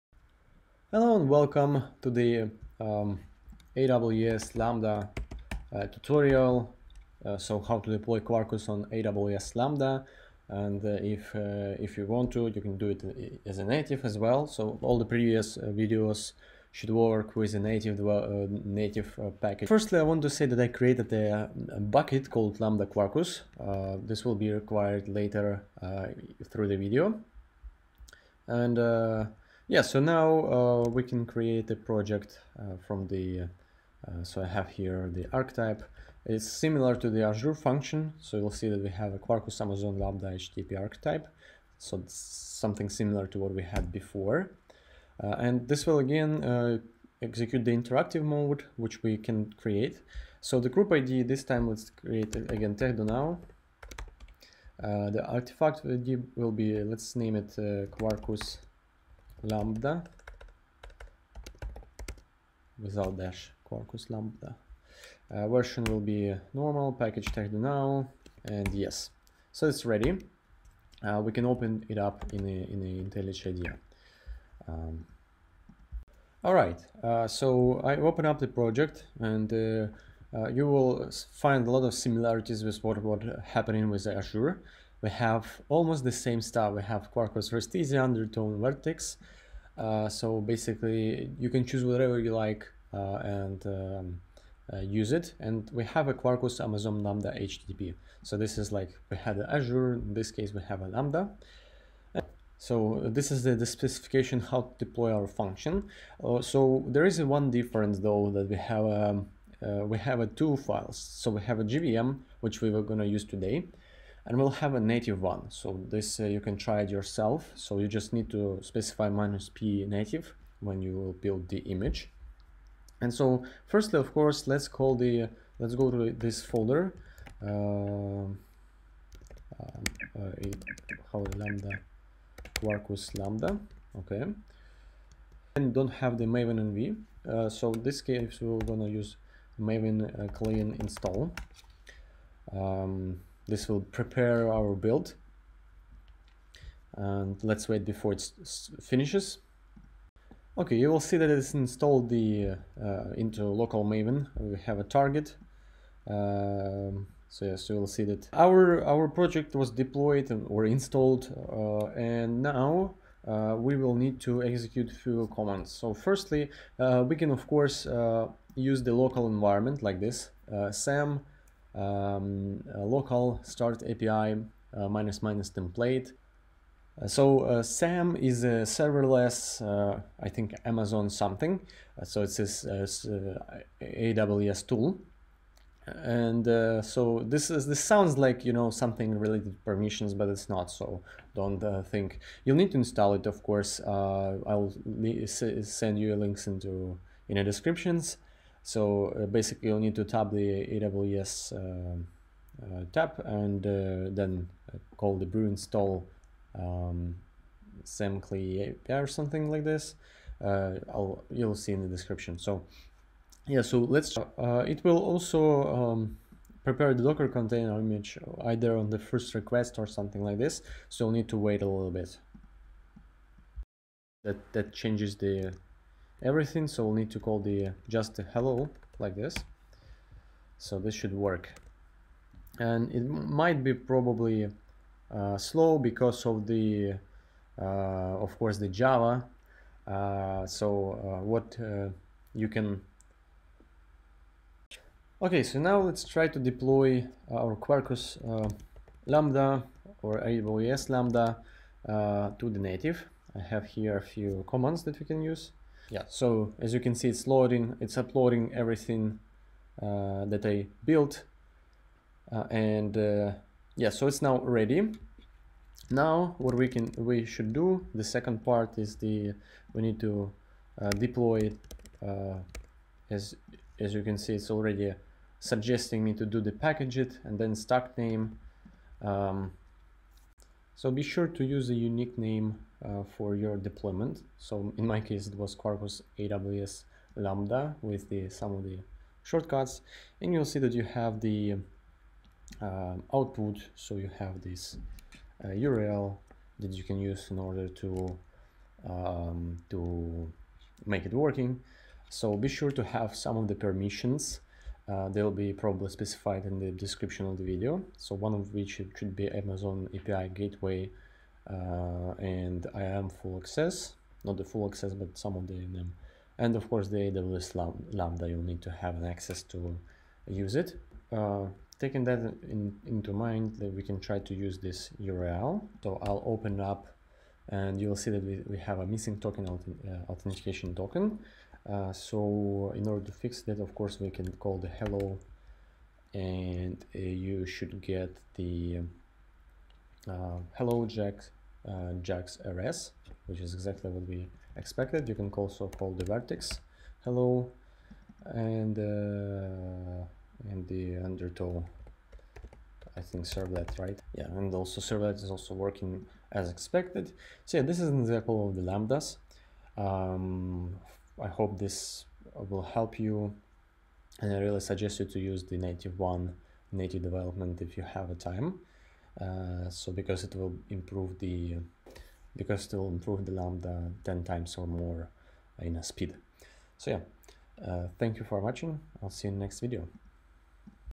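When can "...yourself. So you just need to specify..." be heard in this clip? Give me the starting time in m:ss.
1:56.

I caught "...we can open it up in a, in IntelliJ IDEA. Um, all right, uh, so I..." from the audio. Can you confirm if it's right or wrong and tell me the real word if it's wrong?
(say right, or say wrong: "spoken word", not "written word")
right.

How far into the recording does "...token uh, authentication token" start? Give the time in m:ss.
5:29.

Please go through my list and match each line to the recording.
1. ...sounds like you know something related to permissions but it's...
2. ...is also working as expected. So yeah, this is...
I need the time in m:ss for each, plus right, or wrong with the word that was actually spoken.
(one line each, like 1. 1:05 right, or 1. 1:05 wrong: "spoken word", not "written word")
1. 3:07 right
2. 5:55 right.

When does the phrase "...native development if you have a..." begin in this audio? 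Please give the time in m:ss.
6:06.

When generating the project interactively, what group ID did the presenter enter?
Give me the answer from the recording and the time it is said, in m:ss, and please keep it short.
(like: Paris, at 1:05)
Techdo, at 0:52.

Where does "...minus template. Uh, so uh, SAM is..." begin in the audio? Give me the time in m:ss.
2:55.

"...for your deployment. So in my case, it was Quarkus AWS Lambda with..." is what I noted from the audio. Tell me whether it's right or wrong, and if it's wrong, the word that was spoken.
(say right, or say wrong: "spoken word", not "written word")
right.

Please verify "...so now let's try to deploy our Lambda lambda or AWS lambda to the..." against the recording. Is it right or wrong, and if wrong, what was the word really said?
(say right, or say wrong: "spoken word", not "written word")
wrong: "Quarkus", not "Lambda".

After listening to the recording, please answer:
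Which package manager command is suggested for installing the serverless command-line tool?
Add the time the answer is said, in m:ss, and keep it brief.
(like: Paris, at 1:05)
brew install, at 3:25.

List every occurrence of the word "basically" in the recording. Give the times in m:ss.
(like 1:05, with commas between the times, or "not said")
1:30, 3:19.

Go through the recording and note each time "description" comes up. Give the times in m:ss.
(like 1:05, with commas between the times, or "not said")
3:17, 3:31, 5:06.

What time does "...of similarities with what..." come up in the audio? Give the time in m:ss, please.
1:21.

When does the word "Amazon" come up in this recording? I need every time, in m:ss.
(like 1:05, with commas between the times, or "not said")
0:39, 1:36, 3:00, 5:09.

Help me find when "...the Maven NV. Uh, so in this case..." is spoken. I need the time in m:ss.
2:16.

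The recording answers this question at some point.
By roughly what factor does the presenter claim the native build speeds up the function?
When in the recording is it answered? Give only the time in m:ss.
6:14.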